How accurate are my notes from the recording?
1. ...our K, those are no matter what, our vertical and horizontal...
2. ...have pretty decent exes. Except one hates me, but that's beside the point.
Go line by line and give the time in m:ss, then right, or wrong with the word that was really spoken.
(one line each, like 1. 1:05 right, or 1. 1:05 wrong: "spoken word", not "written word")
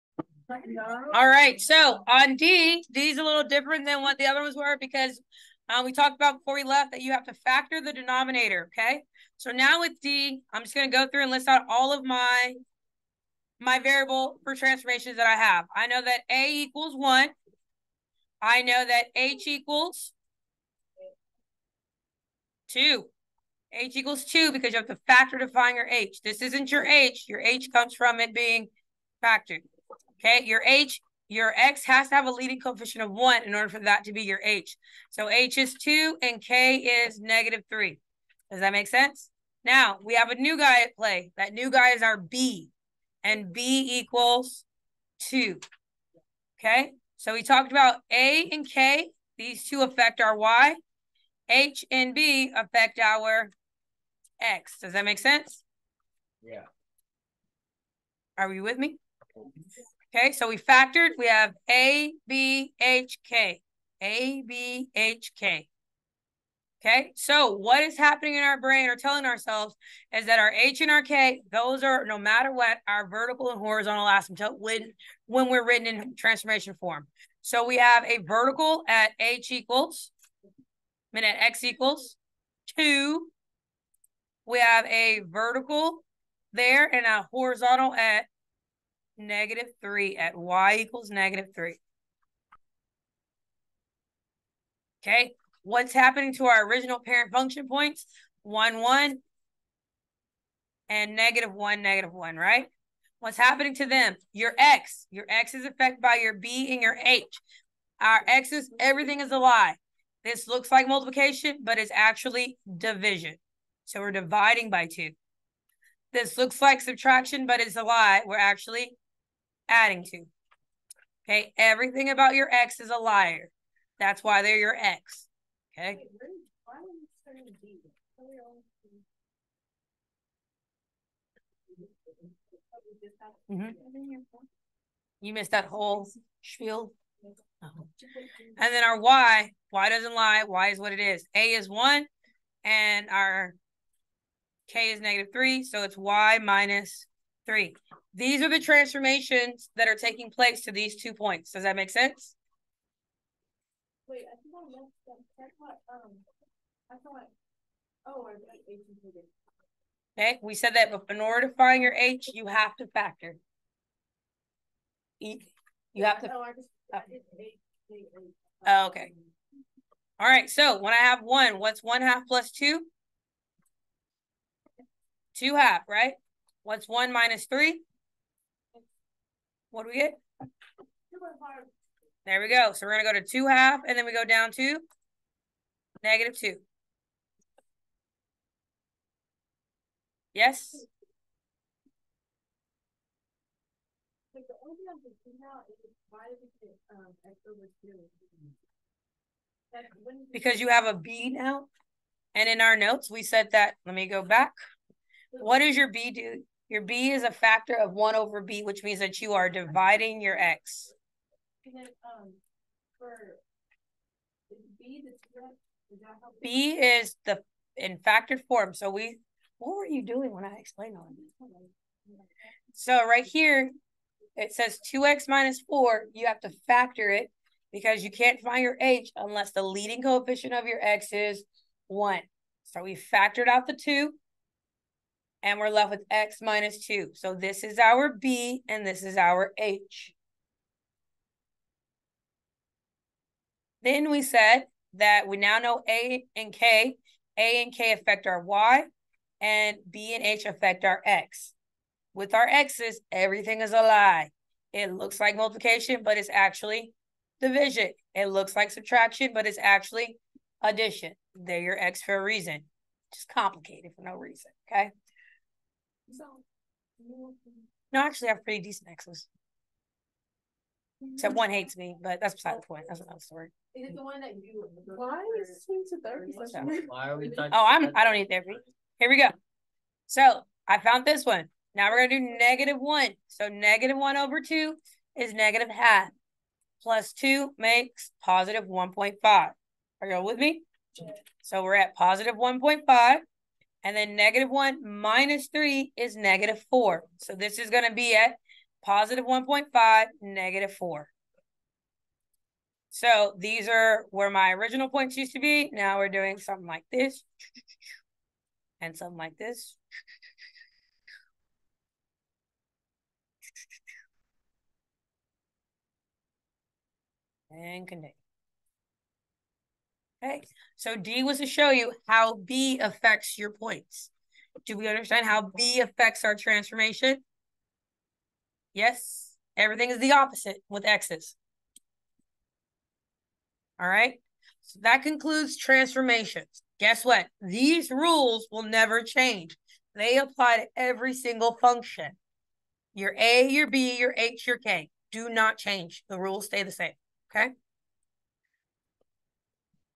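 1. 1:10 right
2. 4:28 right.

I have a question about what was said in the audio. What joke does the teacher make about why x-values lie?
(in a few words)
That's why they're your ex.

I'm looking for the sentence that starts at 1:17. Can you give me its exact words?
So we have a vertical at H equals, I mean at X equals two.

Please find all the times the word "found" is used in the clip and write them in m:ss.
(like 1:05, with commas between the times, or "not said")
4:40.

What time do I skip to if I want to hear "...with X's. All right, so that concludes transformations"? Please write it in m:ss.
5:30.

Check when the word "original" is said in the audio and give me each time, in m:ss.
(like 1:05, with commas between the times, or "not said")
1:36, 5:04.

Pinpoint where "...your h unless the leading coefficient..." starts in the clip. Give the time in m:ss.
3:48.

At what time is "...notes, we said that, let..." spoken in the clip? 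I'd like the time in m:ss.
3:22.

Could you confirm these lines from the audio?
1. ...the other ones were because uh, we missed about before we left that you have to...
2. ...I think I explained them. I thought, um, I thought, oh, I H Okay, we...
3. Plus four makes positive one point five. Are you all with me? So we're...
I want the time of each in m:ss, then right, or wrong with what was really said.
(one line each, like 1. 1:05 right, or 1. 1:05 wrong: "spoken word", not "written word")
1. 0:04 wrong: "talked", not "missed"
2. 2:34 wrong: "missed", not "explained"
3. 4:46 wrong: "two", not "four".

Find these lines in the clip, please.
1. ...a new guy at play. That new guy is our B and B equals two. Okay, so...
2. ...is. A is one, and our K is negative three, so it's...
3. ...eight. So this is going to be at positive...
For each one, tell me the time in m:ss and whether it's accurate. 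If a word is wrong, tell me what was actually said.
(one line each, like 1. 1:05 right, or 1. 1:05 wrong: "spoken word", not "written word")
1. 0:40 right
2. 2:20 right
3. 4:56 wrong: "four", not "eight".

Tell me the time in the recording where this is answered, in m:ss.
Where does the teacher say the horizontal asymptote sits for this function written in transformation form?
1:30.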